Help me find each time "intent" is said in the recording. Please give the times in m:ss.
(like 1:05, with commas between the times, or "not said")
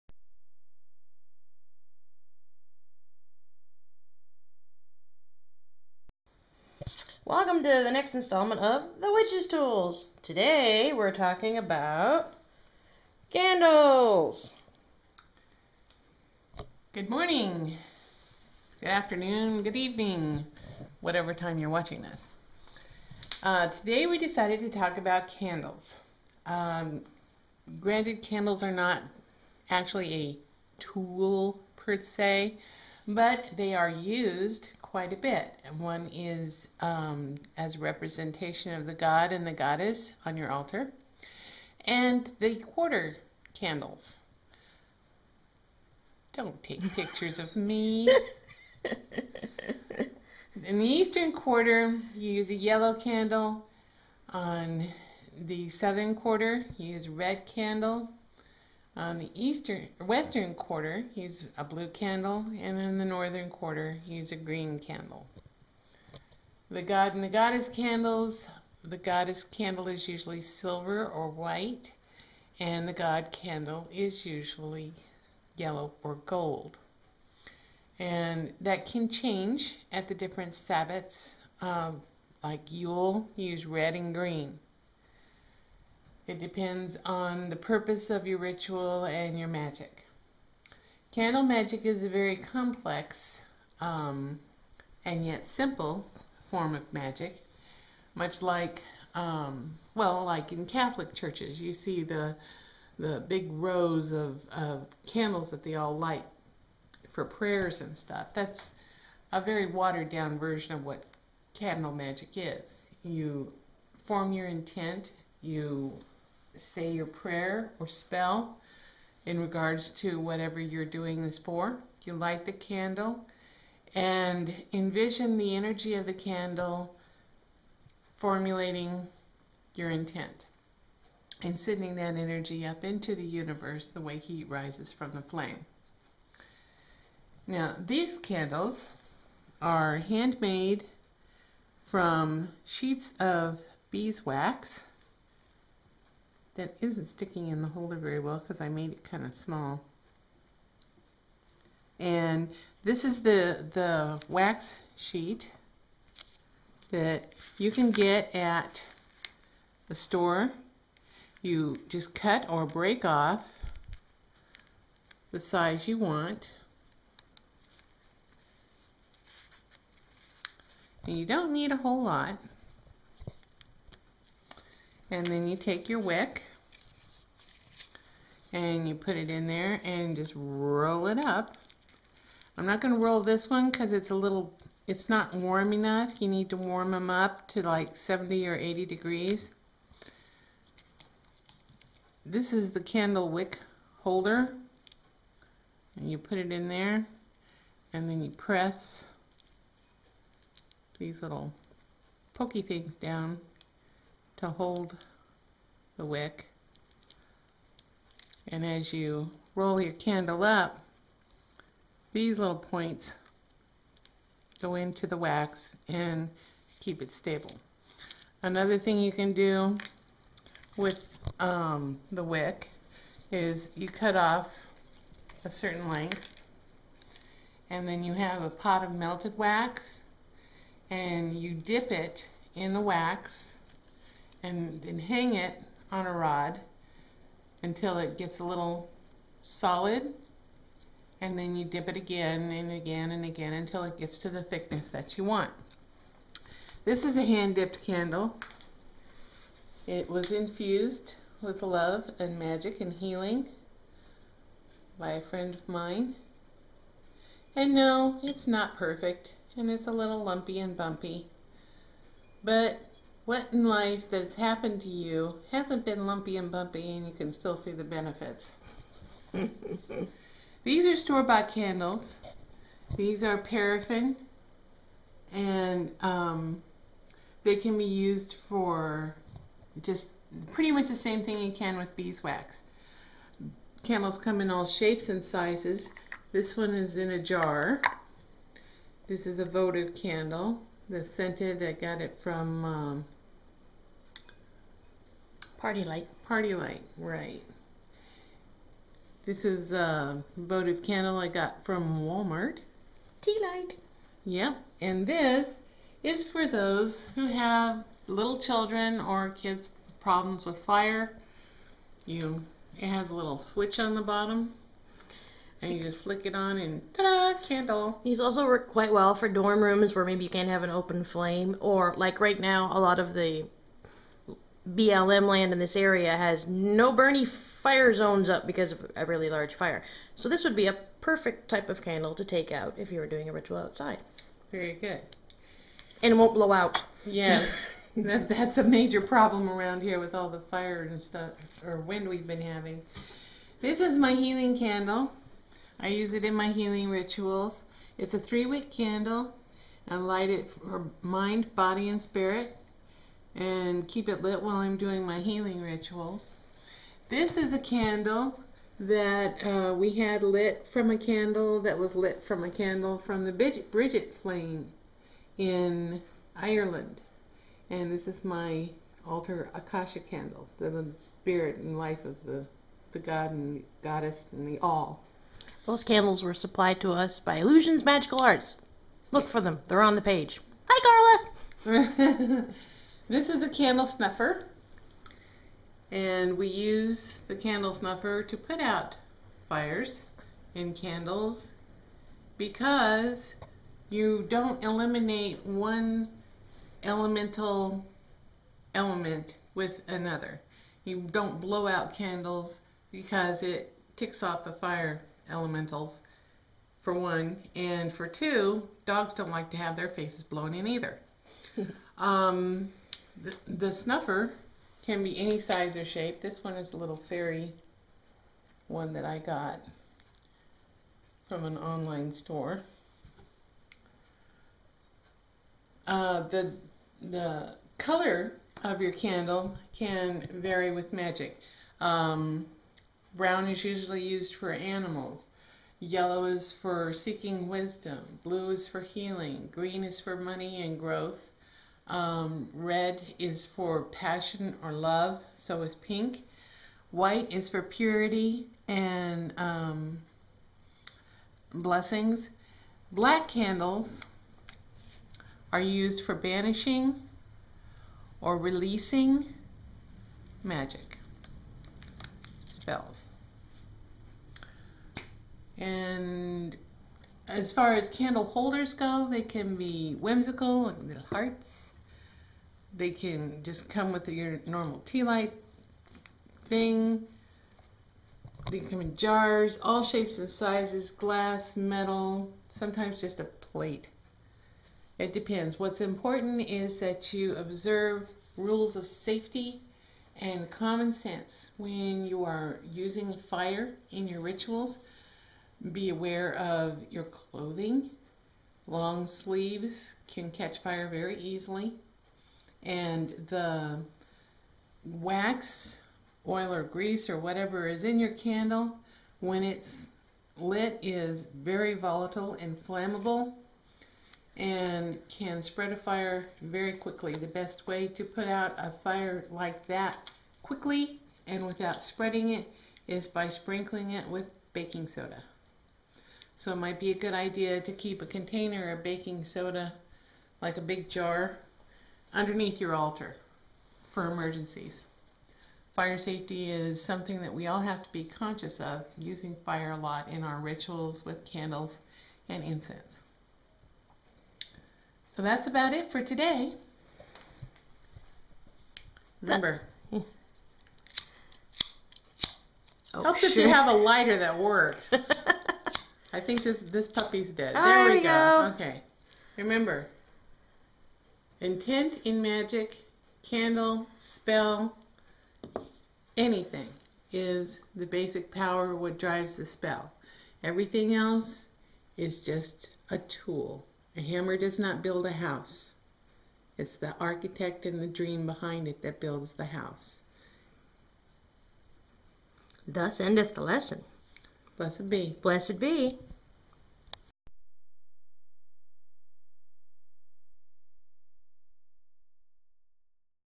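1:54, 2:09, 9:21.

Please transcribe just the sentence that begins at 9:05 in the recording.
So that's about it for today.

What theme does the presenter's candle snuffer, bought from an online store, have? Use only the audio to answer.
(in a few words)
Fairy.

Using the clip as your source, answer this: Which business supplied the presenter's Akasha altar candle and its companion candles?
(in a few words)
Illusions Magical Arts.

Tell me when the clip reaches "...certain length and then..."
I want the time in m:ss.
3:45.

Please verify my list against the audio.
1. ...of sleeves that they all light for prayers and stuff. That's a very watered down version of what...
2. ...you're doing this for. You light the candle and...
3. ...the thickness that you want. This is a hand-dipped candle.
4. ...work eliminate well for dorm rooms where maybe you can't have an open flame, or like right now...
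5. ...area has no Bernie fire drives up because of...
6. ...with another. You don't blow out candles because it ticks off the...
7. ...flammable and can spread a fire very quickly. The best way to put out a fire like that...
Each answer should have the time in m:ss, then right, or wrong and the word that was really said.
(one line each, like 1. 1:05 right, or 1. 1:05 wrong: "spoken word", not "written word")
1. 1:44 wrong: "candles", not "sleeves"
2. 2:00 right
3. 4:04 right
4. 5:18 wrong: "quite", not "eliminate"
5. 5:25 wrong: "zones", not "drives"
6. 6:39 right
7. 8:32 right.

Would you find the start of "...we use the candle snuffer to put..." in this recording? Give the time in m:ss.
6:26.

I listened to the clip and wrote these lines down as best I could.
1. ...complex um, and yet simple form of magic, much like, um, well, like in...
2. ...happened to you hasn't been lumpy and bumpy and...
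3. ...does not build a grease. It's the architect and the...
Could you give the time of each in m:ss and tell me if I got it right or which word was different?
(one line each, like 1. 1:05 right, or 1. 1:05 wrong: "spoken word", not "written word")
1. 1:32 right
2. 4:24 right
3. 9:34 wrong: "house", not "grease".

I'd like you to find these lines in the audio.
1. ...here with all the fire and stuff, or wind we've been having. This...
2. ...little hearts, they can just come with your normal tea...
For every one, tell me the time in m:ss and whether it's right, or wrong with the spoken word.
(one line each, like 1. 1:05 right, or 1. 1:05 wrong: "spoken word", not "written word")
1. 5:39 right
2. 7:50 right.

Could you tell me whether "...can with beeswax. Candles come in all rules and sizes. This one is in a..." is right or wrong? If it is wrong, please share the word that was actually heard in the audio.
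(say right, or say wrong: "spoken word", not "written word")
wrong: "shapes", not "rules".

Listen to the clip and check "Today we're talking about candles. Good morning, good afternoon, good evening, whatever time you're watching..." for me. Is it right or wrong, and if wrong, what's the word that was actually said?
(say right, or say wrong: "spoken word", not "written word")
right.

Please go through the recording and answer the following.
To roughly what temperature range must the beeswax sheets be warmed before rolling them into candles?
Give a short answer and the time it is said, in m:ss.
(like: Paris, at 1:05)
70 or 80 degrees, at 3:07.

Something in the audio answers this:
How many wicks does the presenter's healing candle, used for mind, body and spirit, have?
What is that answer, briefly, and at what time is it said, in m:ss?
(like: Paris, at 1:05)
3, at 5:48.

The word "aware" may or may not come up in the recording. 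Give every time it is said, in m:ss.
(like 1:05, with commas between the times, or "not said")
8:15.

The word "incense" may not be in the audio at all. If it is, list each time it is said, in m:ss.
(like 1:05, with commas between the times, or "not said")
9:02.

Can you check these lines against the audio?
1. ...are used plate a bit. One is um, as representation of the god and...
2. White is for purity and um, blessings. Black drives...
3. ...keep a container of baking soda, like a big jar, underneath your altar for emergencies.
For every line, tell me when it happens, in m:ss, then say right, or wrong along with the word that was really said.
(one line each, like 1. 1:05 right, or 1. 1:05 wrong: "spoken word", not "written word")
1. 0:33 wrong: "quite", not "plate"
2. 7:26 wrong: "candles", not "drives"
3. 8:47 right.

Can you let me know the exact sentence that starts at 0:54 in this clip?
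On the southern quarter, you use red candle.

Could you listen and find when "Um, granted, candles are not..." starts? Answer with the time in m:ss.
0:26.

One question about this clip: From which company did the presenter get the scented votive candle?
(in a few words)
PartyLite.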